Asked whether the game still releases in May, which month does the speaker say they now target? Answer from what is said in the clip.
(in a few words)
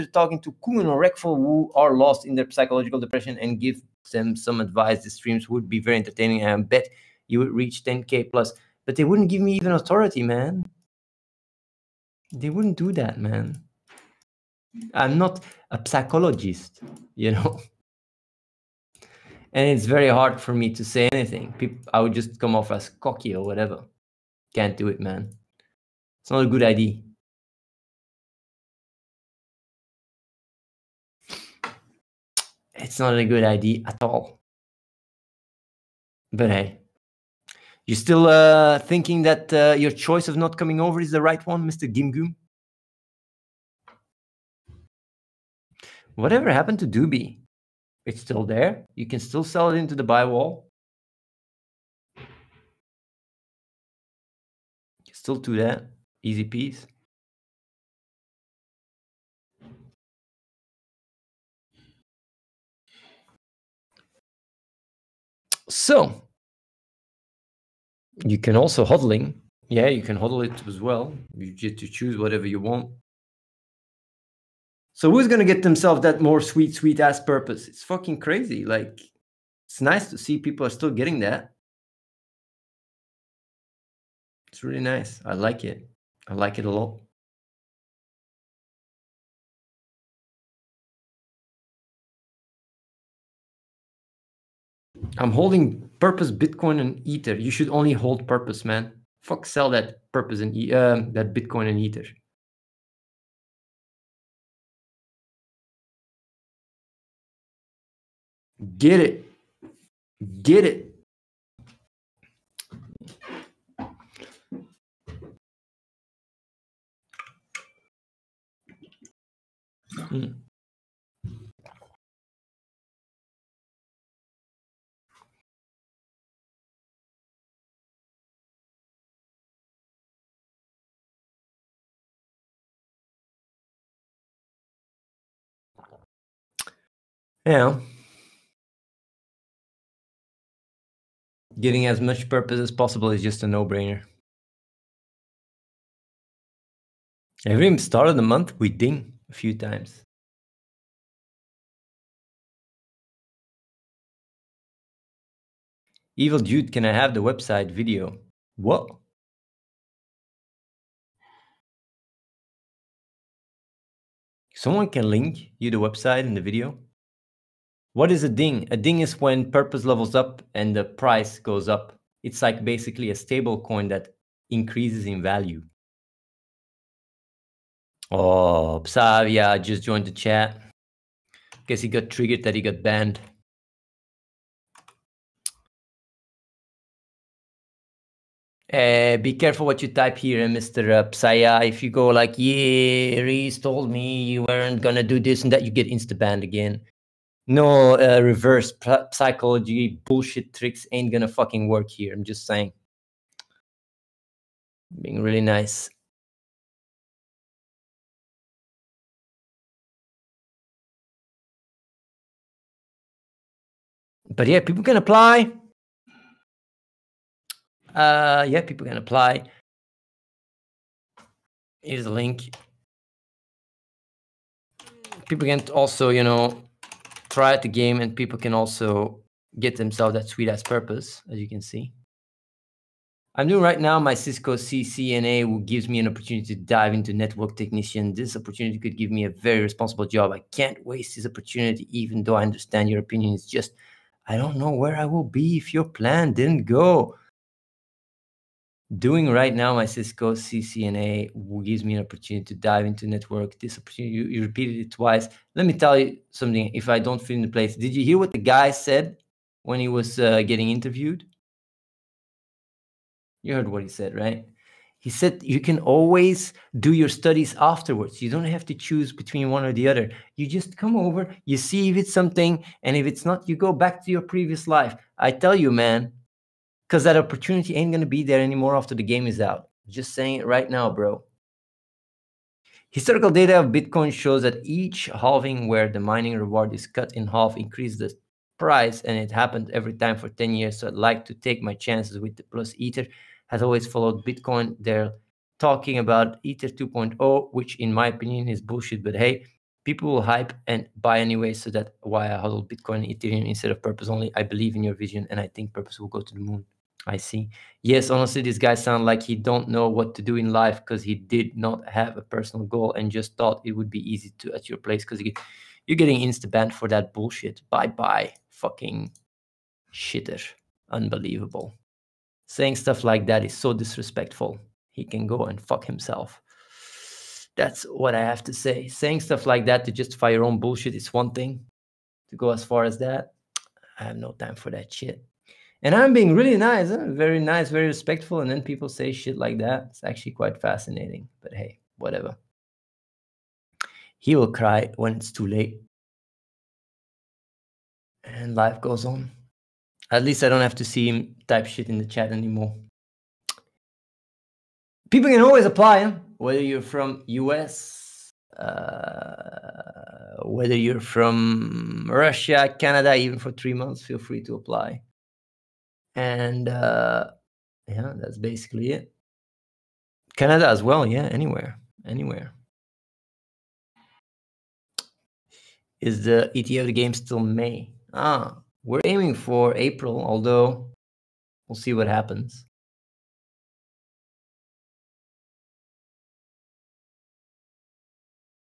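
April.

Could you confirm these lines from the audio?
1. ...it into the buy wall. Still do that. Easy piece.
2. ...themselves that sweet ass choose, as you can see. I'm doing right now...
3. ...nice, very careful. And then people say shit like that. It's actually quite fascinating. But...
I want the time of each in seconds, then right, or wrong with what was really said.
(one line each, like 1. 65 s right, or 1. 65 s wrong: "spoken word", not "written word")
1. 49 s right
2. 229 s wrong: "purpose", not "choose"
3. 337 s wrong: "respectful", not "careful".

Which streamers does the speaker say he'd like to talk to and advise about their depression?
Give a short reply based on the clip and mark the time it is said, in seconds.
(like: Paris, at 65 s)
Kumin or Reckful, at 0 s.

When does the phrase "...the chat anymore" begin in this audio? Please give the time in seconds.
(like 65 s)
351 s.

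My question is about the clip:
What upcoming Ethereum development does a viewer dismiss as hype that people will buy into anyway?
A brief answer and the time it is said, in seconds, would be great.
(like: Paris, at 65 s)
Ether 2.0, at 296 s.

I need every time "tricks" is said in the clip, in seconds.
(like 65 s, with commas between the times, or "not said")
200 s.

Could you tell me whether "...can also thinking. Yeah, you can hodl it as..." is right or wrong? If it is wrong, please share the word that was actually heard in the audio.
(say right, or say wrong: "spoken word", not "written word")
wrong: "hodling", not "thinking".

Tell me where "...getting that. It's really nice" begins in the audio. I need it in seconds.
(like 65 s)
80 s.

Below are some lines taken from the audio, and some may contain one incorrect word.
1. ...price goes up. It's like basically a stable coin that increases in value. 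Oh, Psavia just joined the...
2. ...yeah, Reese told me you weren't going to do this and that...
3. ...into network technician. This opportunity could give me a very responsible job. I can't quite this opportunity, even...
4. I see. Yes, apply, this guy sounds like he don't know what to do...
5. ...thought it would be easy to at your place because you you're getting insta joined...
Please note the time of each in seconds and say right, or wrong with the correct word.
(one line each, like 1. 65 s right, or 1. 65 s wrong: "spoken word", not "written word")
1. 170 s right
2. 192 s right
3. 236 s wrong: "waste", not "quite"
4. 307 s wrong: "honestly", not "apply"
5. 313 s wrong: "banned", not "joined".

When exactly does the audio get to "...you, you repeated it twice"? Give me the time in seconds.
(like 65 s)
254 s.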